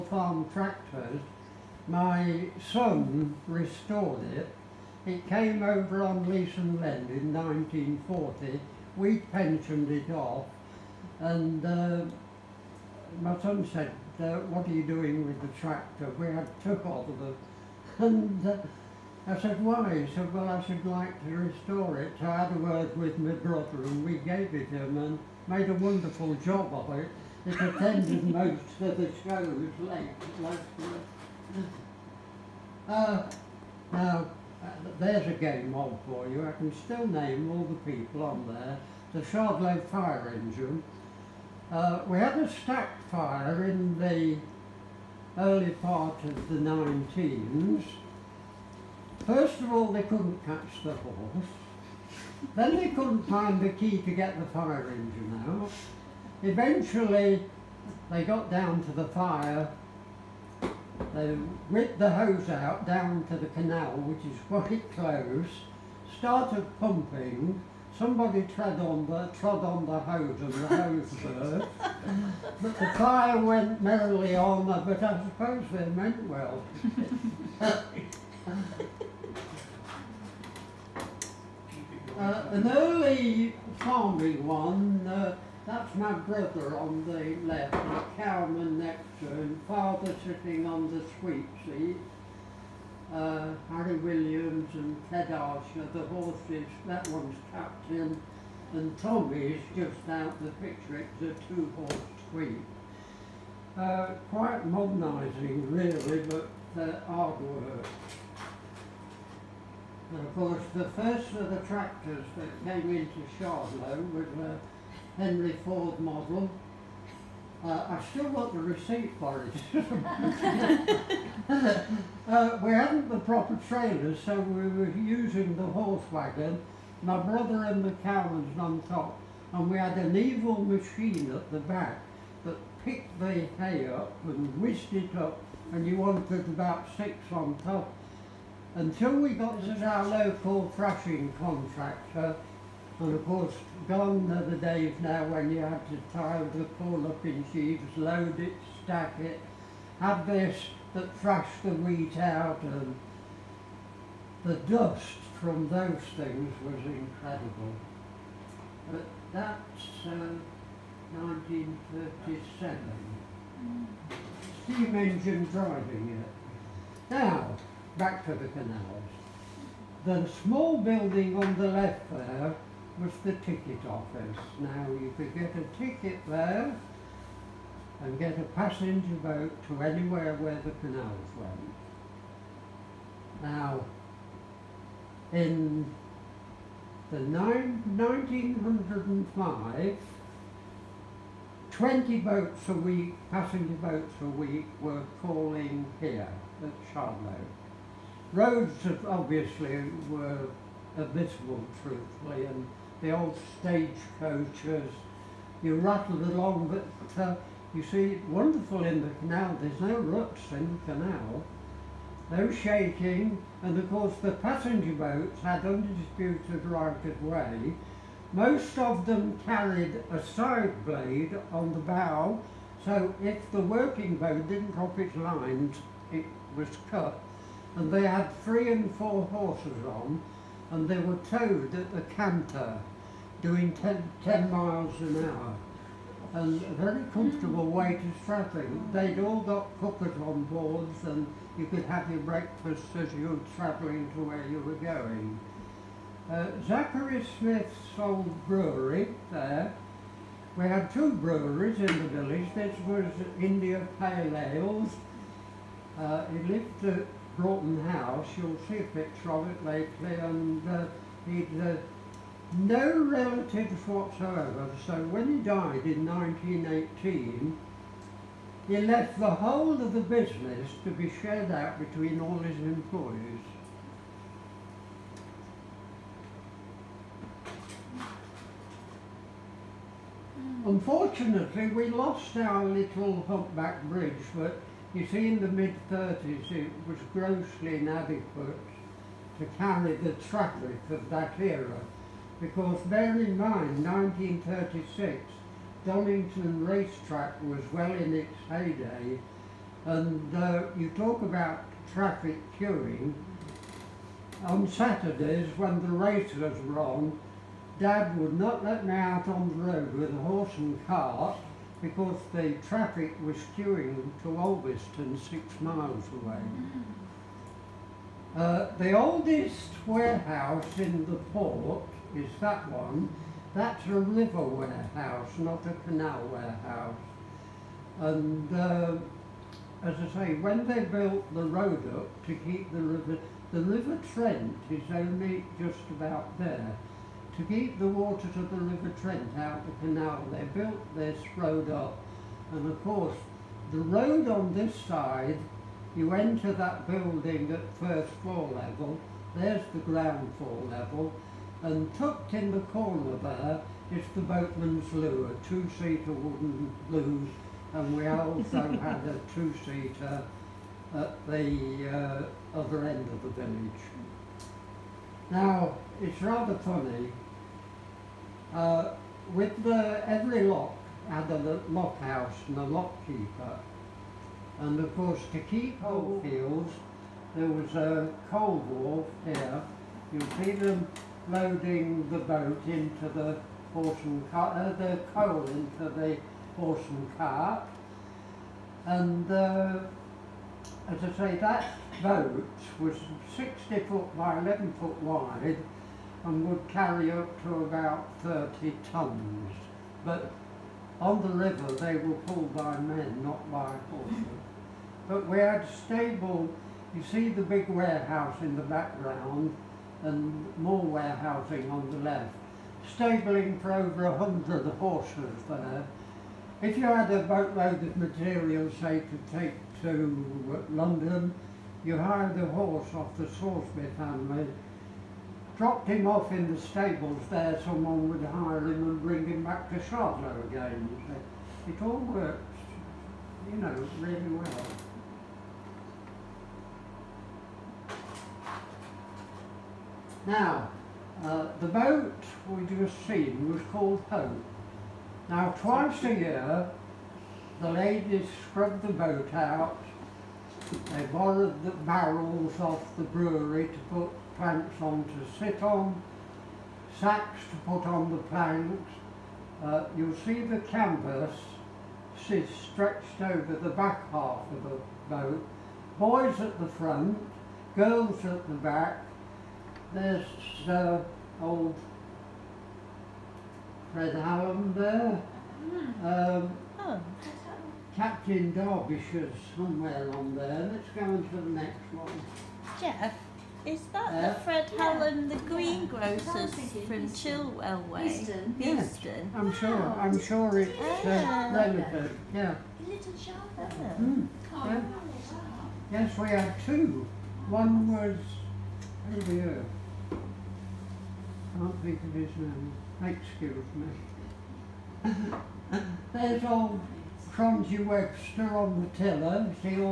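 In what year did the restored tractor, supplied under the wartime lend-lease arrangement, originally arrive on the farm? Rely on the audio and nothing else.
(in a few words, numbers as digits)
1940.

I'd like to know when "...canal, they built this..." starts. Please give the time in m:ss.
5:39.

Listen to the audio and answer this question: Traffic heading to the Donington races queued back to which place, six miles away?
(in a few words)
Alvaston.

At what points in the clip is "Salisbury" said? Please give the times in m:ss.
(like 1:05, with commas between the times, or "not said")
7:03.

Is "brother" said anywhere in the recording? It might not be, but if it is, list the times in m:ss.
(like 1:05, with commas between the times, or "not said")
0:23, 1:26, 2:07.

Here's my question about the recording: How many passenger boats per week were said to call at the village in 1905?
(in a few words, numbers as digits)
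20.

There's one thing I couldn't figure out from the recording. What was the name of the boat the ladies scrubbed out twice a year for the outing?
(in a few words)
Hope.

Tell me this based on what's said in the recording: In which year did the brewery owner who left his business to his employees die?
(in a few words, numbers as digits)
1918.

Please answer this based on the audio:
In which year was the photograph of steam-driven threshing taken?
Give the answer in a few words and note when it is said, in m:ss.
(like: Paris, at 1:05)
1937, at 2:41.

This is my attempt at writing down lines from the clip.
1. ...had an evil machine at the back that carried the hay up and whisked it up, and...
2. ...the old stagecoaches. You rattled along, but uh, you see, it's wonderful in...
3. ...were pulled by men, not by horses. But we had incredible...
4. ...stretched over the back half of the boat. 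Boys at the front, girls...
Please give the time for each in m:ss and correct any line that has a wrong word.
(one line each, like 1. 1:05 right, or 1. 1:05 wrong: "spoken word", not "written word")
1. 2:09 wrong: "picked", not "carried"
2. 3:23 right
3. 6:41 wrong: "stable", not "incredible"
4. 7:42 right.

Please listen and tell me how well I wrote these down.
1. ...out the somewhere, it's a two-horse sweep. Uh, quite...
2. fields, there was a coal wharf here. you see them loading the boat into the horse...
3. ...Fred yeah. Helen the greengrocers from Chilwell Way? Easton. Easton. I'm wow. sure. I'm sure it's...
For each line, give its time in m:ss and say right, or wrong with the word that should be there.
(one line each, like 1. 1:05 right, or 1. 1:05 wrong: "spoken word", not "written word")
1. 1:40 wrong: "picture", not "somewhere"
2. 6:16 right
3. 8:04 right.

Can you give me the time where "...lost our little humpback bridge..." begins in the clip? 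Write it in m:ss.
4:41.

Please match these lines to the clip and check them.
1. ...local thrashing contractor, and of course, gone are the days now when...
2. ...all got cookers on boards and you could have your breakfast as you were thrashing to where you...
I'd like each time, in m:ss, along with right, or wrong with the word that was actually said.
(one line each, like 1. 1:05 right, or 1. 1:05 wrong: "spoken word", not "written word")
1. 2:20 right
2. 3:59 wrong: "travelling", not "thrashing".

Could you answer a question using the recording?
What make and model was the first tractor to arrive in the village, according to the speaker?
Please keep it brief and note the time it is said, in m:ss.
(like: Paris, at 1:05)
Henry Ford model, at 1:55.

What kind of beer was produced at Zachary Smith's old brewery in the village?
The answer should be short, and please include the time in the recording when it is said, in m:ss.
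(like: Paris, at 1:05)
India Pale Ales, at 4:13.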